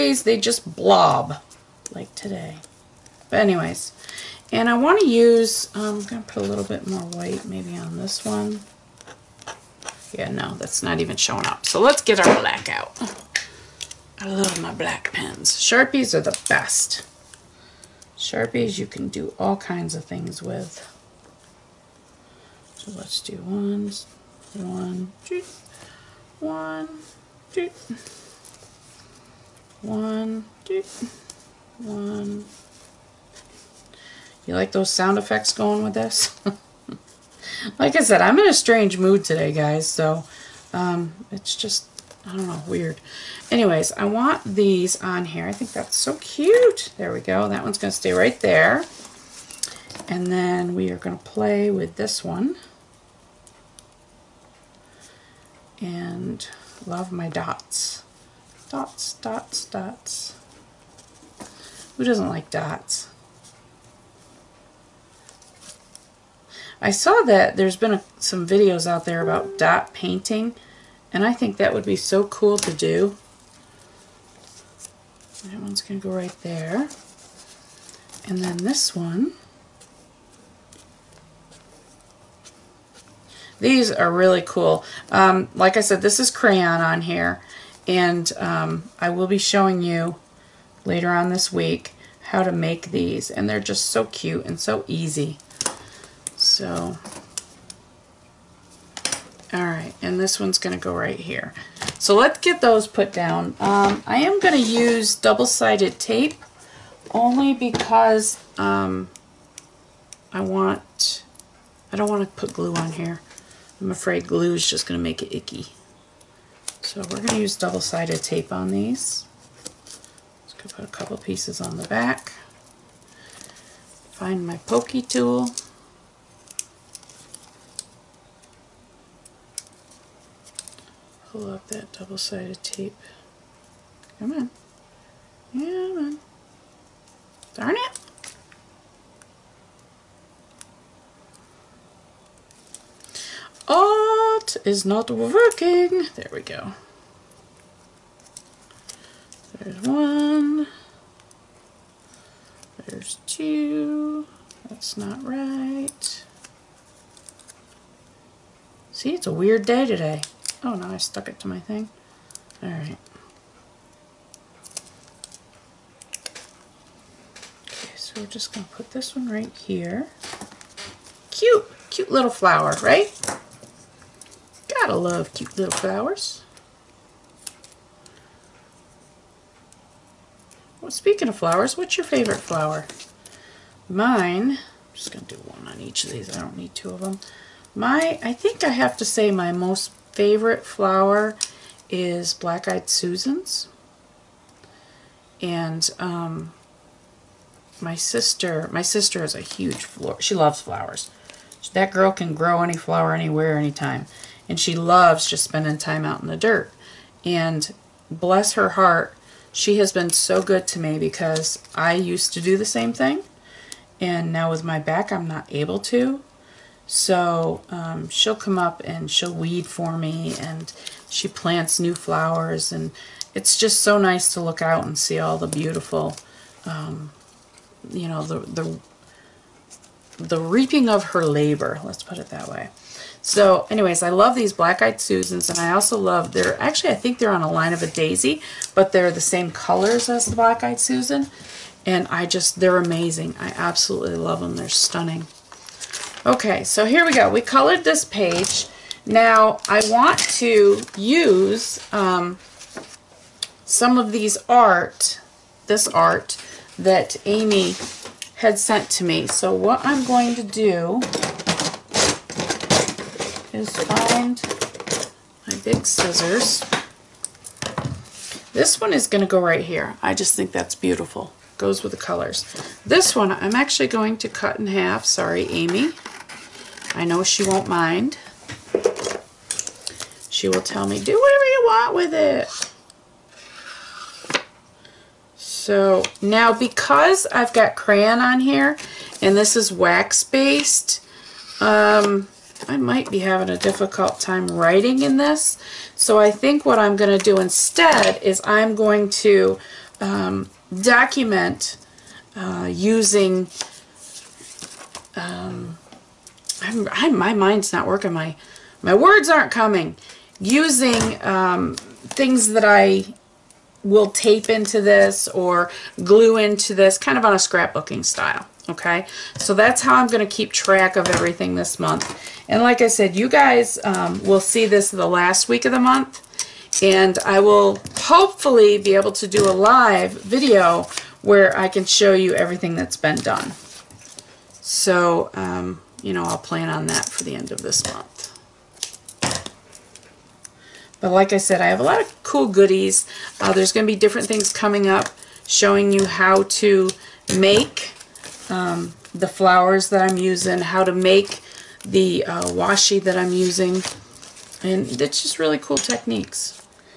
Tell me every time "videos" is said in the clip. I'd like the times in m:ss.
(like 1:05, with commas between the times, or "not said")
1:08, 5:30.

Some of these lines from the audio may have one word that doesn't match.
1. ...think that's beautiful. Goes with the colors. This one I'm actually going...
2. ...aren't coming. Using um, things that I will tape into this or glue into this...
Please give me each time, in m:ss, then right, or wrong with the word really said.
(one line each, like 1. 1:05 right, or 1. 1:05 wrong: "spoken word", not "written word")
1. 4:30 right
2. 5:09 right.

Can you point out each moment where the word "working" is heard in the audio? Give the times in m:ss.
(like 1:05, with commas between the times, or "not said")
2:25, 5:07.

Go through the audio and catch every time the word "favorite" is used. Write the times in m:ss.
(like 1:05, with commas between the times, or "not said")
3:02, 3:10.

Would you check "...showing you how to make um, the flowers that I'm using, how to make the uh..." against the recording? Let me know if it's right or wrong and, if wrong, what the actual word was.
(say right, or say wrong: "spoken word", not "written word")
right.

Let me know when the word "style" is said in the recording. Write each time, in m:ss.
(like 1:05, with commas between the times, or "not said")
5:18.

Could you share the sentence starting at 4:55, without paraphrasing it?
So I think what I'm going to do instead is I'm going to um, document uh, using...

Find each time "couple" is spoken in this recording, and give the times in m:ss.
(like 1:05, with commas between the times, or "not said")
2:00.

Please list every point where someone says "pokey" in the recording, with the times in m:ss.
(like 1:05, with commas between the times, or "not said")
2:04.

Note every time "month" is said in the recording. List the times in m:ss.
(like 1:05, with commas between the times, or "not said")
5:21, 5:25, 5:37.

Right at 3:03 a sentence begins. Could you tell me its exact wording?
Mine, I'm just going to do one on each of these.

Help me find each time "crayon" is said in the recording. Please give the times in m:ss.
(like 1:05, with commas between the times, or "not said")
1:26, 4:47.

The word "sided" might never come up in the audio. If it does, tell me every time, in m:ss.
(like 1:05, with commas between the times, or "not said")
1:45, 1:57, 2:11.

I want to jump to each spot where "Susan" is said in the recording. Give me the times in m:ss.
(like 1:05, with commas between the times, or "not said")
3:12, 3:54, 4:00.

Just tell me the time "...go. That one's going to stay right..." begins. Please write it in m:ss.
0:47.